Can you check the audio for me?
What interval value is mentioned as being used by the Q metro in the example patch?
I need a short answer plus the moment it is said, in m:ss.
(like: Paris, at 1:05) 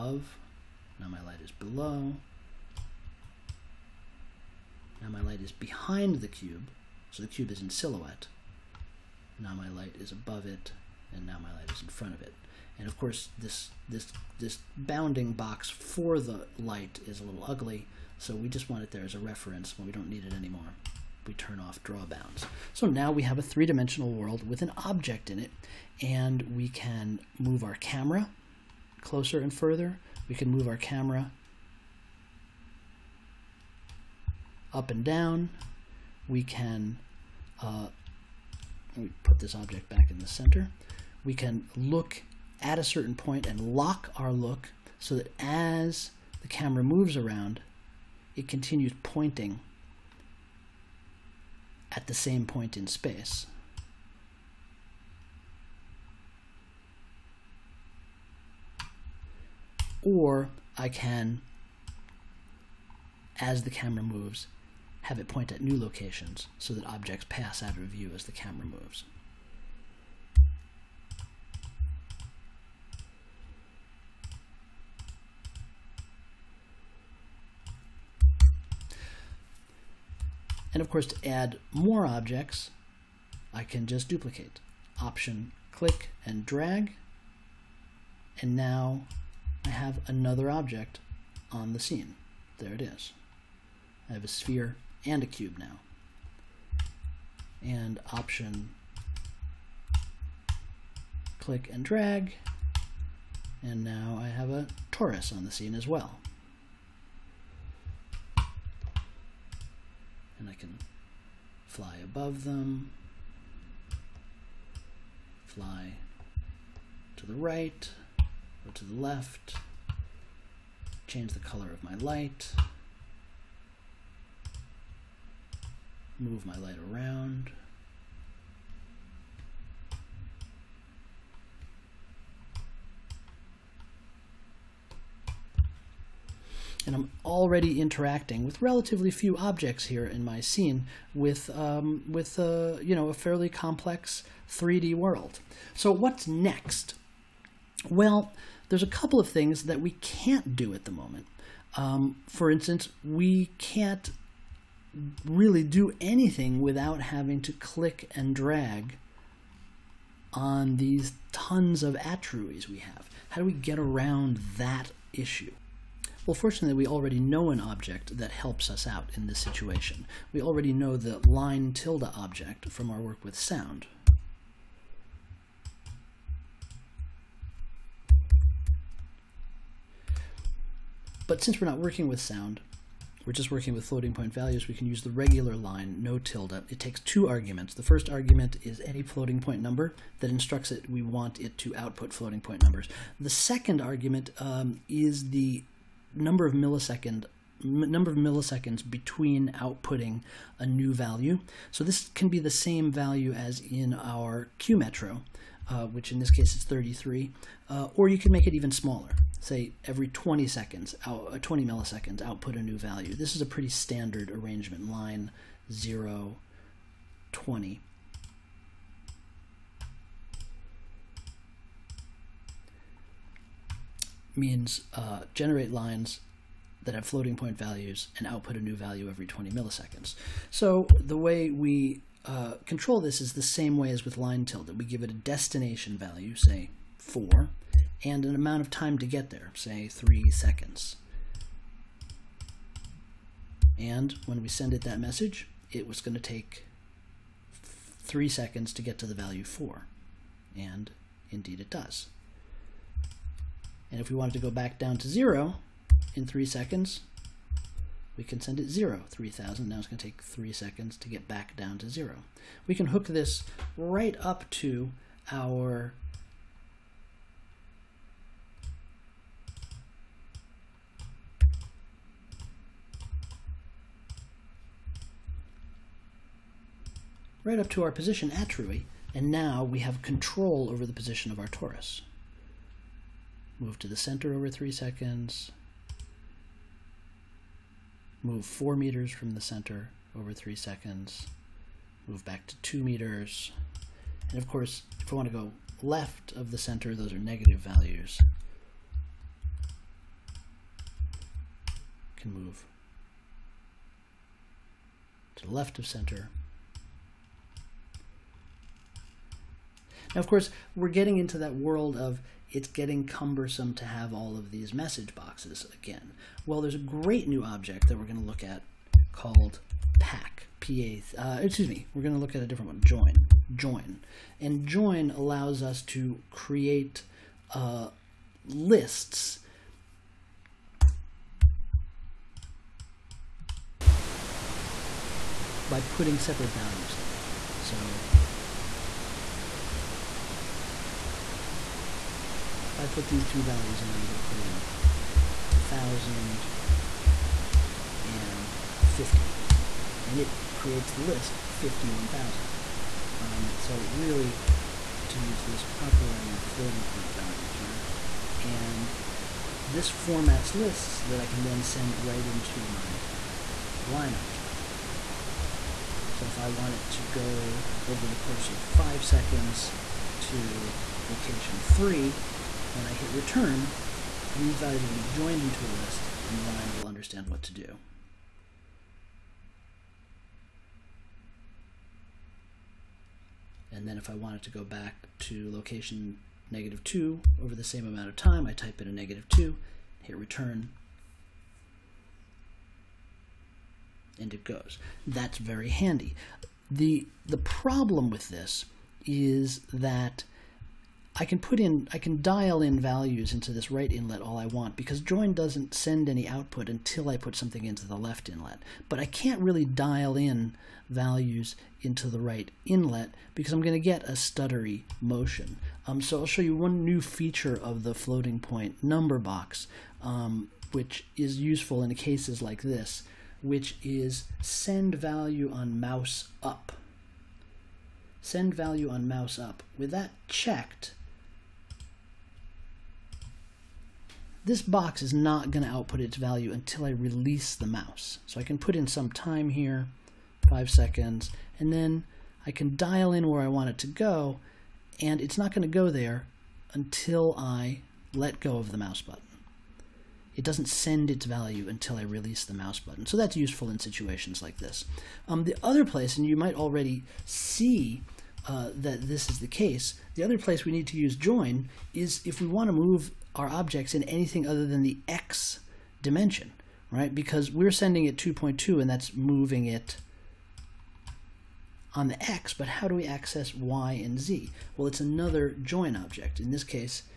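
33, at 3:26.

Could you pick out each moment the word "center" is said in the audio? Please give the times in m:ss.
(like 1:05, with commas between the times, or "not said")
0:40, 4:43, 4:49, 4:56, 5:05.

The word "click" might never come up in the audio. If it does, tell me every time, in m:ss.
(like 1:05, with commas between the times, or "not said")
1:25, 1:41, 2:37.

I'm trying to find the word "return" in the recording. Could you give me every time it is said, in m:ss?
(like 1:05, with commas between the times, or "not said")
6:13, 6:30.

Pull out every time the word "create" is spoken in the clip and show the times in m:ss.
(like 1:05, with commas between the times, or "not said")
5:26, 5:50.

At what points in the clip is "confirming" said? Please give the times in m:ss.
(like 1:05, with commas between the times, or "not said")
not said.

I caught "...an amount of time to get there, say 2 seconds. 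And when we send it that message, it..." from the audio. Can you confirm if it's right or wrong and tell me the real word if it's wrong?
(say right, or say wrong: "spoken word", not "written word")
wrong: "3", not "2".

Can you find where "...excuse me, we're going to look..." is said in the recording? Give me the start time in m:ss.
5:21.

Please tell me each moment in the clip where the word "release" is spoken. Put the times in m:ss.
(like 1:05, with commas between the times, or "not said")
7:16, 7:32.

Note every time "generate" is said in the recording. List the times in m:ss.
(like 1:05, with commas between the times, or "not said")
3:45.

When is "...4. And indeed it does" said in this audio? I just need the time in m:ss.
4:09.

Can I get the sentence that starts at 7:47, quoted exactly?
Because we're sending it 2.2 and that's moving it on the x, but how do we access y and z?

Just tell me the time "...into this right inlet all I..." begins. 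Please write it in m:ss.
6:43.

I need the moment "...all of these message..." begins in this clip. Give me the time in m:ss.
5:14.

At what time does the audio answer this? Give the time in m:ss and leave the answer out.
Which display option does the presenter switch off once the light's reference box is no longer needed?
0:21.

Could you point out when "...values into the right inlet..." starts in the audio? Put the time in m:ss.
6:50.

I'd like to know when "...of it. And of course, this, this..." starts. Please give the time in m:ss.
0:12.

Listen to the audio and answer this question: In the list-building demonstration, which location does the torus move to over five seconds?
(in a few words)
3.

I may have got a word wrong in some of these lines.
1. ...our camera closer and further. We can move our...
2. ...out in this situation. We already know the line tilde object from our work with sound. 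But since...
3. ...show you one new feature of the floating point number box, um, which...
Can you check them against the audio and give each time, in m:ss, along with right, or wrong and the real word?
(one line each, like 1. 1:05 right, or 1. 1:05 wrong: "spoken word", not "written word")
1. 0:27 right
2. 2:48 right
3. 6:56 right.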